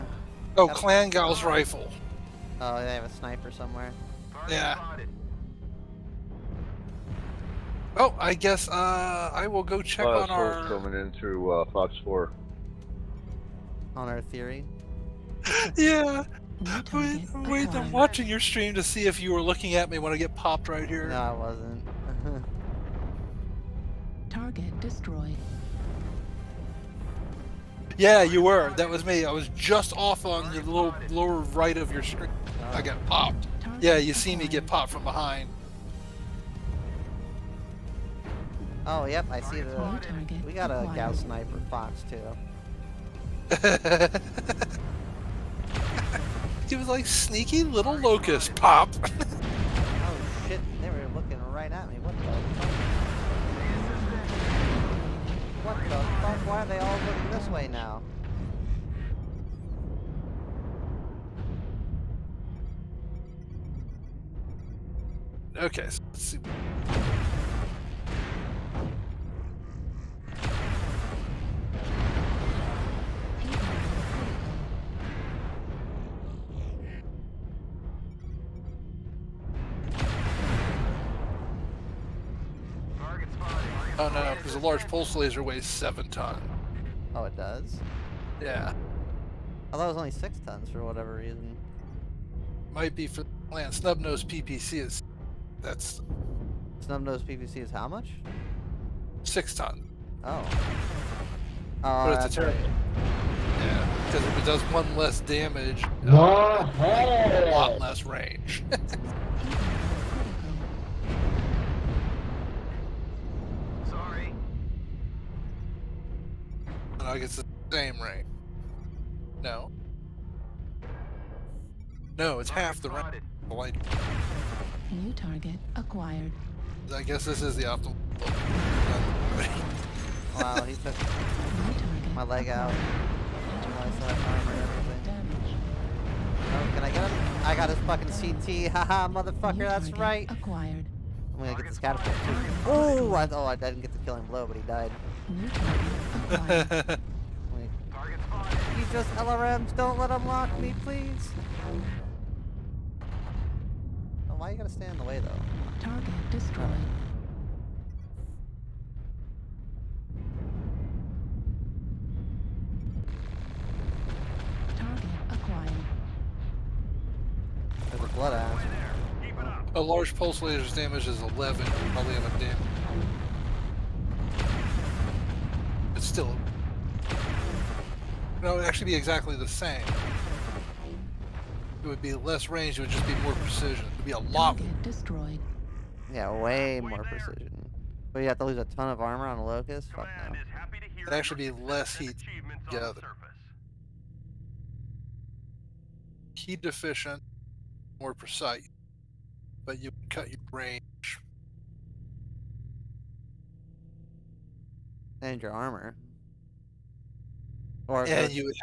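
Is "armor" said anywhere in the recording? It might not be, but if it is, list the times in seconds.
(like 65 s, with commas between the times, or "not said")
188 s, 205 s.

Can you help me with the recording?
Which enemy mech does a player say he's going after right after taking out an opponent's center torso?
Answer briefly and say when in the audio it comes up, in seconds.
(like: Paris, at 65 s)
Catapult, at 141 s.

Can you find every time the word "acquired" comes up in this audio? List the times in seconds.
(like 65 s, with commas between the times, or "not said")
125 s, 140 s, 165 s.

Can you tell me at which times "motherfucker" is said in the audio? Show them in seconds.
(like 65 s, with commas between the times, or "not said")
139 s.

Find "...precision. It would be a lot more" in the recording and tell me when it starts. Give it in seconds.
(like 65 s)
183 s.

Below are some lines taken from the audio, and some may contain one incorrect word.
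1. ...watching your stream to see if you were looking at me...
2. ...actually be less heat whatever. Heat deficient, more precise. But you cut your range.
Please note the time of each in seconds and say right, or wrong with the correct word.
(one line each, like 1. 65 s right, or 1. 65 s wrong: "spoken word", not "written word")
1. 17 s right
2. 191 s wrong: "together", not "whatever".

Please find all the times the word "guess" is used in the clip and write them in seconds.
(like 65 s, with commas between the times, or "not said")
8 s, 127 s.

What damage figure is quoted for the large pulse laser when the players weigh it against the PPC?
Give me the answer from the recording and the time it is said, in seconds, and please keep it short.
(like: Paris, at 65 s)
11, at 171 s.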